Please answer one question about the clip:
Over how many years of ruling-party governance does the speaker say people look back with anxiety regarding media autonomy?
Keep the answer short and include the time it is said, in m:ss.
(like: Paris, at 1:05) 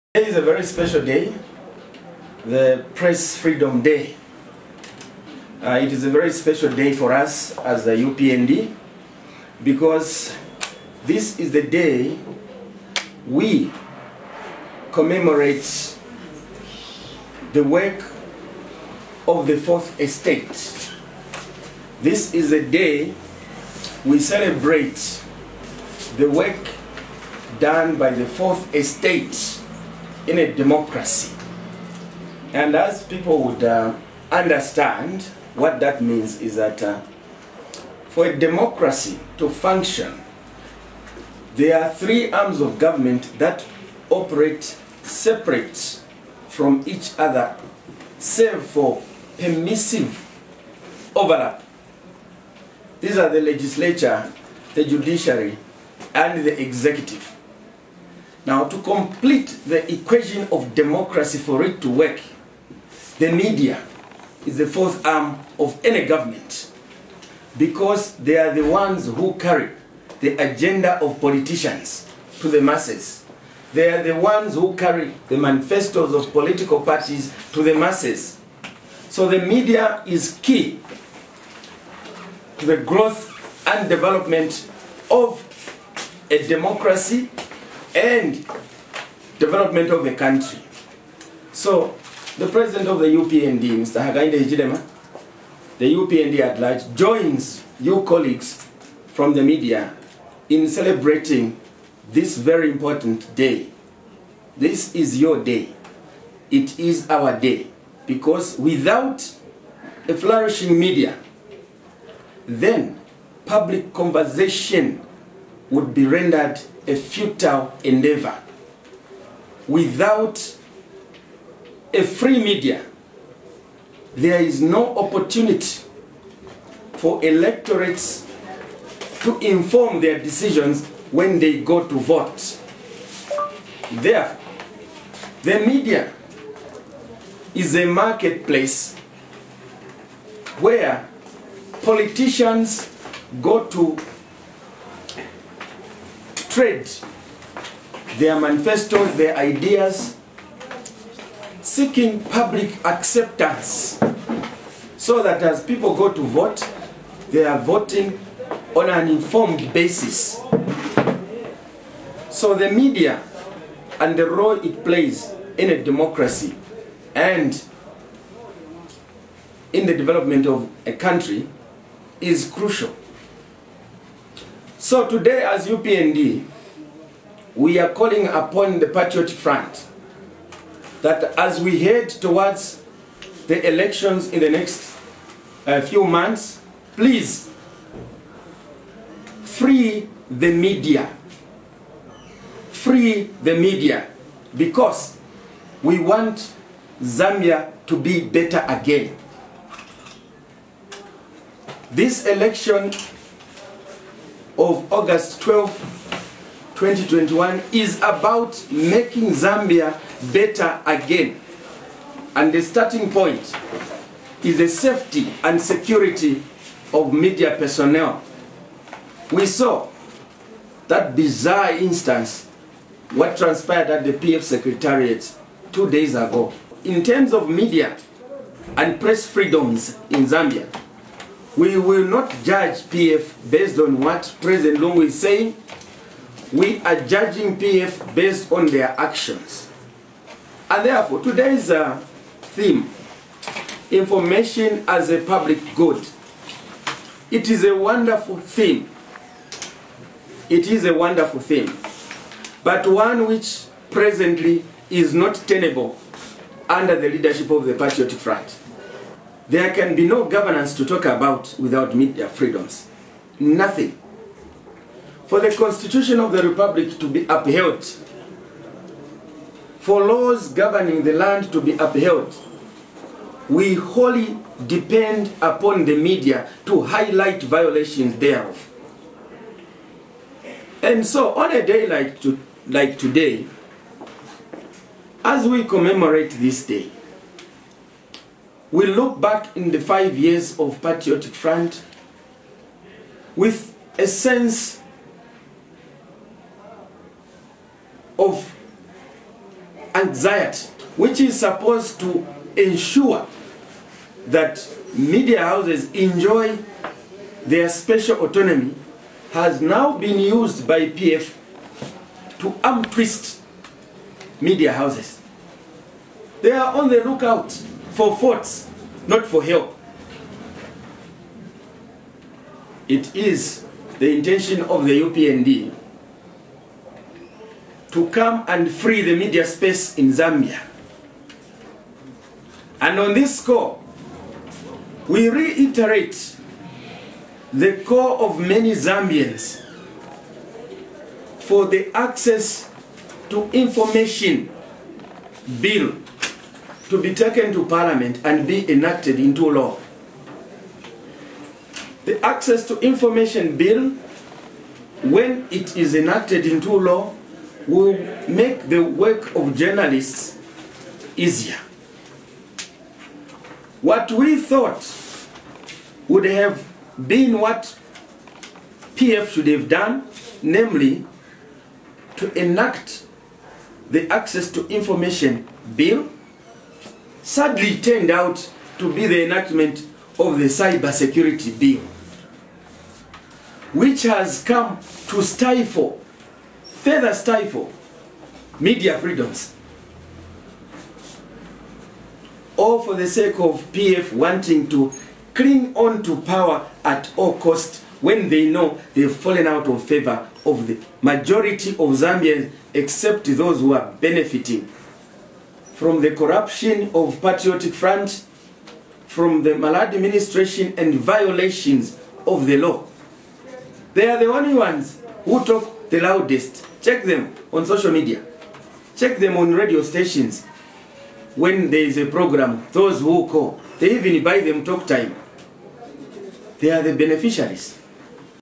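5, at 4:49.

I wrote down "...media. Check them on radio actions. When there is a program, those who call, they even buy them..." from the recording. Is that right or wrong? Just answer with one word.
wrong.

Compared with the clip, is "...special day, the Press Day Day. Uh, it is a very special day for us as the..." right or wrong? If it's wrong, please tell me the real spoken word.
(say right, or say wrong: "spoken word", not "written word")
wrong: "Freedom", not "Day".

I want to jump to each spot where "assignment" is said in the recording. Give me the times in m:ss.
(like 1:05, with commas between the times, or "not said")
not said.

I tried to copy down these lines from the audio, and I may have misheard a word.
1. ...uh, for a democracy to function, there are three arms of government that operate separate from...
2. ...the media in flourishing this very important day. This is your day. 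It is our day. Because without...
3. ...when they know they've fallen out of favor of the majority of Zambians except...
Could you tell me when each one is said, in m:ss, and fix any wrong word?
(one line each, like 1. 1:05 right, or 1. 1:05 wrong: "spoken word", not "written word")
1. 0:36 right
2. 1:39 wrong: "celebrating", not "flourishing"
3. 6:38 right.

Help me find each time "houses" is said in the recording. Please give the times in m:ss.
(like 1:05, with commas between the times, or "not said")
5:05, 5:14.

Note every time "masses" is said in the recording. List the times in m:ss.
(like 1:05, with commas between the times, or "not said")
1:12, 1:17.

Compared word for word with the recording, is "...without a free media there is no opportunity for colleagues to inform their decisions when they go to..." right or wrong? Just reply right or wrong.
wrong.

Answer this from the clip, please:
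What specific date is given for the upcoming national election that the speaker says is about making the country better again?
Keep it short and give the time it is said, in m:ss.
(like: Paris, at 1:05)
August 12, 2021, at 3:24.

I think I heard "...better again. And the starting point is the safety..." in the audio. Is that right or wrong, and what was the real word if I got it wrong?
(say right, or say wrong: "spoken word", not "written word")
right.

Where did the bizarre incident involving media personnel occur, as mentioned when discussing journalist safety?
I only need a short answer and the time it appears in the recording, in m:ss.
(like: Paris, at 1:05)
PF Secretariat, at 3:44.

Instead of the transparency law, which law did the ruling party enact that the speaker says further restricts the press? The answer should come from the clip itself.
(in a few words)
Cyber Security Bill.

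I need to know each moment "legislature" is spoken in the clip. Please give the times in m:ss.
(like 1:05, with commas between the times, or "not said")
0:53.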